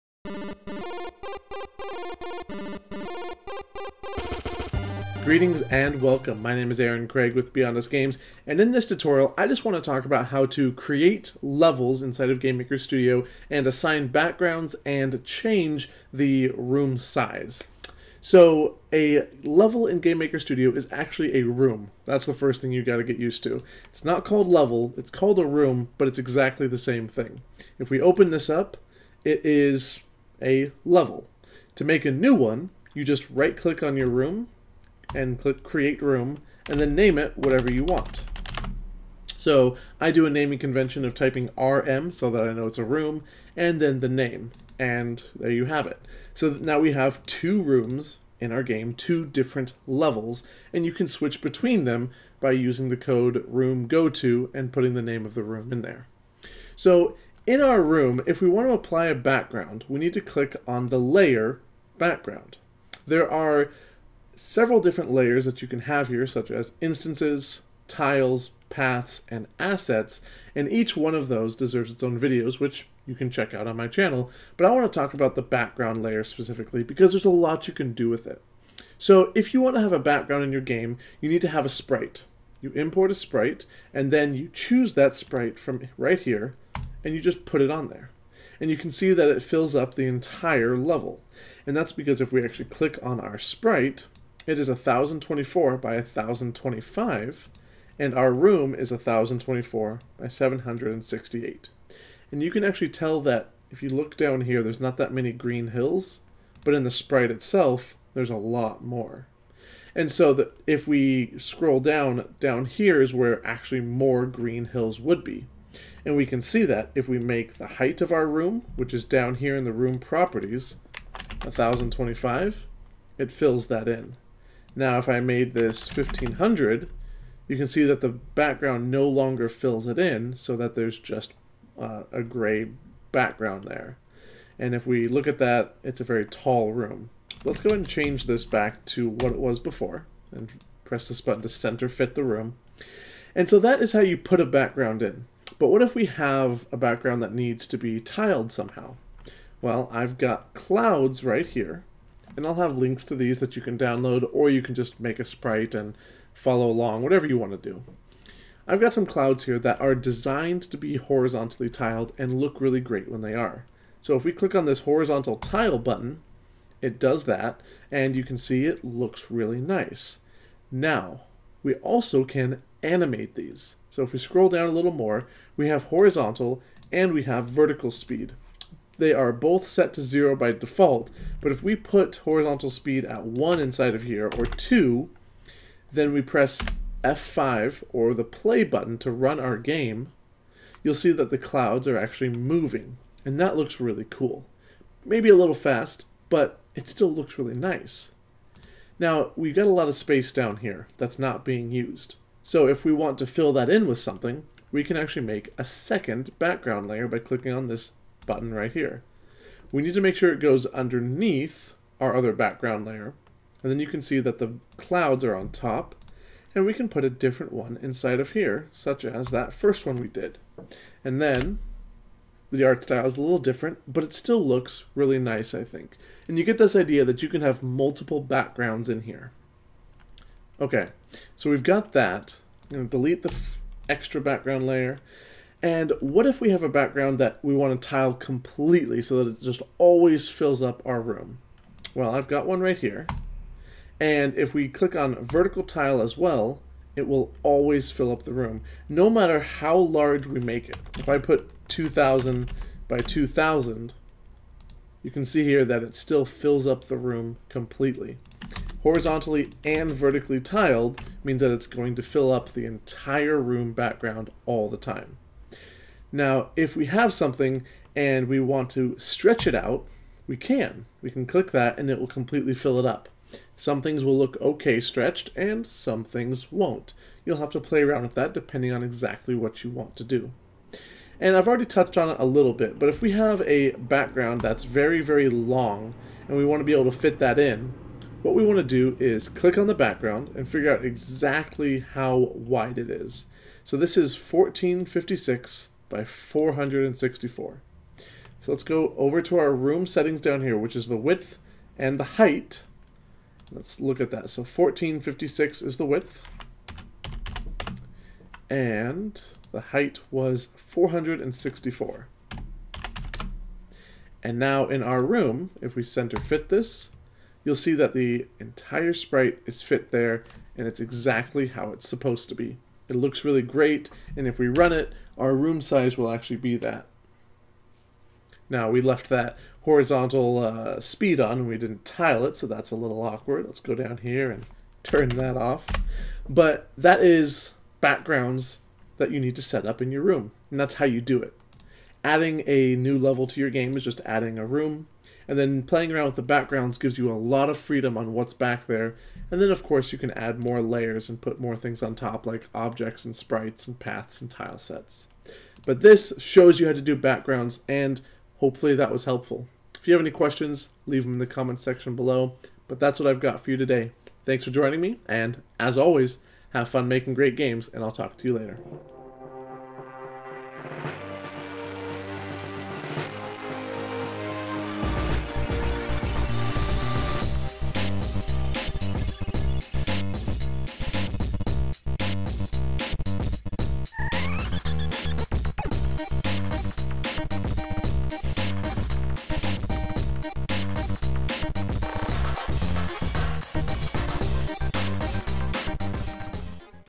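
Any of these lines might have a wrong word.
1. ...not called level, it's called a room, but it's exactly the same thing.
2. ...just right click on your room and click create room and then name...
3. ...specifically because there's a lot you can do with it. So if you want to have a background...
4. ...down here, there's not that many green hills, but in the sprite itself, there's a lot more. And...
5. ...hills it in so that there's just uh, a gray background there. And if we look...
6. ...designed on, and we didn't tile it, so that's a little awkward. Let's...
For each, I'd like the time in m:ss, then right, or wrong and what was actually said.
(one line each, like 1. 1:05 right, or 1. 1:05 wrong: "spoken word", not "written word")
1. 0:24 right
2. 0:33 right
3. 1:16 right
4. 1:44 right
5. 2:09 wrong: "fills", not "hills"
6. 5:30 wrong: "speed", not "designed".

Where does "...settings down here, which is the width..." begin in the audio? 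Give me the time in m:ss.
4:59.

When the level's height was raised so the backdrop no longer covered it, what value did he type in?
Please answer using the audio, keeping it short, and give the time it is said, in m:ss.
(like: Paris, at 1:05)
1500, at 2:05.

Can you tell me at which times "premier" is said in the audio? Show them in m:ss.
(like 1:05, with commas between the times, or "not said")
not said.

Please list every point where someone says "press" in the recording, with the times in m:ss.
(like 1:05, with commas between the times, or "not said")
2:20, 3:06.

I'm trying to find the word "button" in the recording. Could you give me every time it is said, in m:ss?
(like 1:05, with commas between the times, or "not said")
2:21, 2:45, 3:08, 3:28.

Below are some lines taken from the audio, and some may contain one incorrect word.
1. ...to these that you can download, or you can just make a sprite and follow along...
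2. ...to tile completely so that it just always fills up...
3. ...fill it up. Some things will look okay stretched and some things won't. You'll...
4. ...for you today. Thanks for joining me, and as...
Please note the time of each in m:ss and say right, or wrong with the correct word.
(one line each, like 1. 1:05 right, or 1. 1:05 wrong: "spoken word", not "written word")
1. 2:33 right
2. 3:57 right
3. 4:32 right
4. 6:03 right.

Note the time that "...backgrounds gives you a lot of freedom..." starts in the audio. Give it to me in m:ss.
5:46.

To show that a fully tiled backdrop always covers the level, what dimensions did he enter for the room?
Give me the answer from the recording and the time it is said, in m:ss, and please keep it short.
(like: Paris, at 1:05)
2,000 by 2,000, at 4:11.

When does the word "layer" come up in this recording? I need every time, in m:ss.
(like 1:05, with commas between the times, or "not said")
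1:00, 1:05, 1:16, 3:26, 3:32, 3:54, 5:50.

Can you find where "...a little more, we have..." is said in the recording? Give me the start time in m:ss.
2:54.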